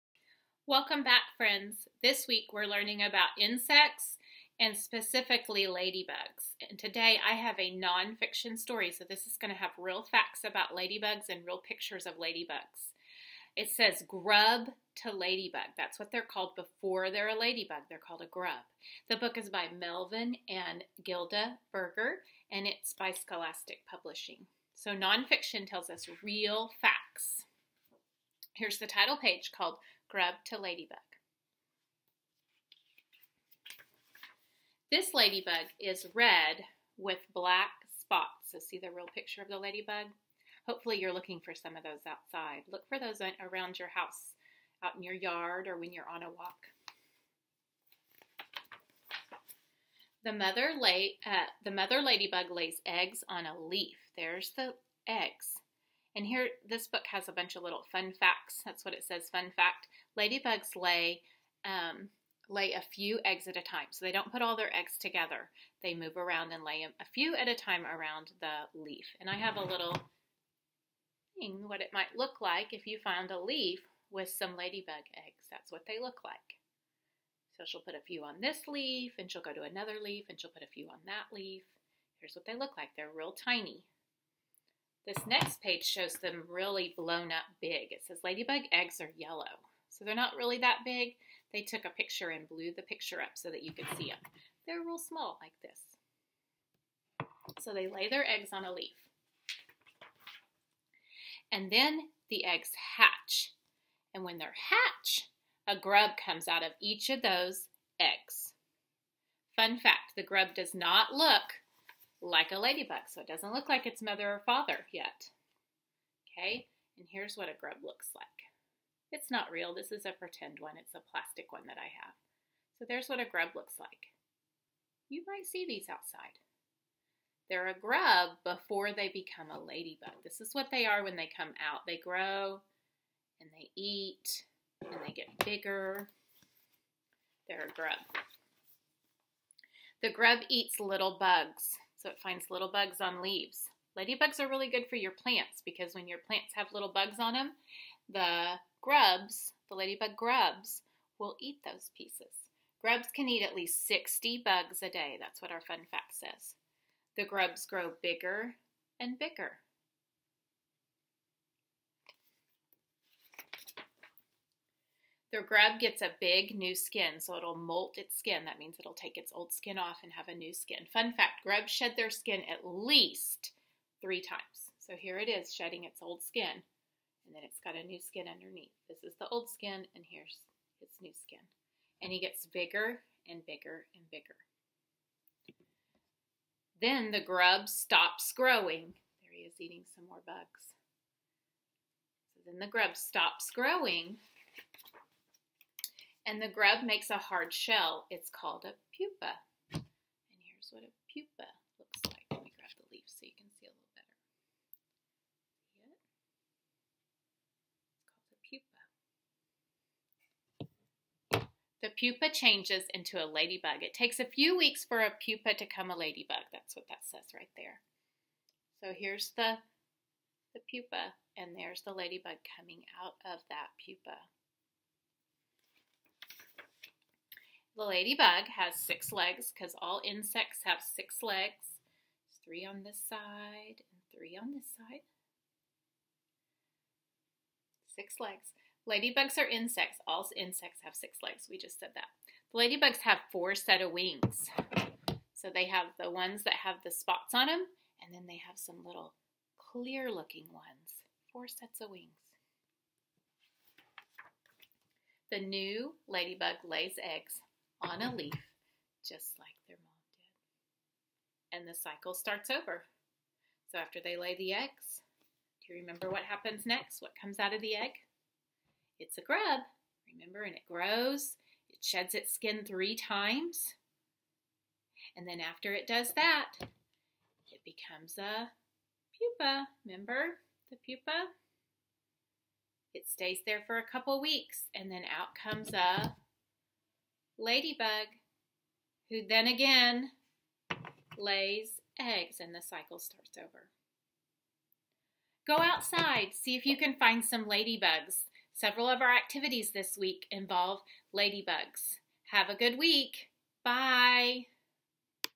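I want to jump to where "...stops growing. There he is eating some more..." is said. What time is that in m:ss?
3:07.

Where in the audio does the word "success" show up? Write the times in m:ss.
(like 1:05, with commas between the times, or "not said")
not said.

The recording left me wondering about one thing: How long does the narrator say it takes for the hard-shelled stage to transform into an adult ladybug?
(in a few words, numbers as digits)
A few weeks.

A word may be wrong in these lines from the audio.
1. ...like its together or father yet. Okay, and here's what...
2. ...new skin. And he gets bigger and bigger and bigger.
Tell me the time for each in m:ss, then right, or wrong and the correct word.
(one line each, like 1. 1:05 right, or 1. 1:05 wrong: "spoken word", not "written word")
1. 1:53 wrong: "mother", not "together"
2. 3:01 right.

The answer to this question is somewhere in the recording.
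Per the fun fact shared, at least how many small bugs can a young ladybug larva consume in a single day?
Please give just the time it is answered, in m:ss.
2:33.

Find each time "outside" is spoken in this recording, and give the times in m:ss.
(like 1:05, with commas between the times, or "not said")
0:42, 2:05, 4:55.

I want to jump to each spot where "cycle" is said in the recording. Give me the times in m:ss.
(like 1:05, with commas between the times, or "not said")
4:21, 4:52.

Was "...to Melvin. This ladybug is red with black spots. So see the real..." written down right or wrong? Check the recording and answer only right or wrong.
wrong.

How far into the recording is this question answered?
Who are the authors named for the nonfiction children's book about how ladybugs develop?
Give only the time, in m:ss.
0:19.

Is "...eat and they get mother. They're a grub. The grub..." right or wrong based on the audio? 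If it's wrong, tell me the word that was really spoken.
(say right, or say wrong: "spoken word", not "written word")
wrong: "bigger", not "mother".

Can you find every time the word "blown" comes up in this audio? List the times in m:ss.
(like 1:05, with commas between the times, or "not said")
1:26.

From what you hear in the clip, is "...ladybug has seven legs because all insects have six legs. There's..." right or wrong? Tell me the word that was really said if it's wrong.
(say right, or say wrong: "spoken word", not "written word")
wrong: "six", not "seven".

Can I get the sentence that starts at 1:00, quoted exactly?
Ladybugs lay um, lay a few eggs at a time.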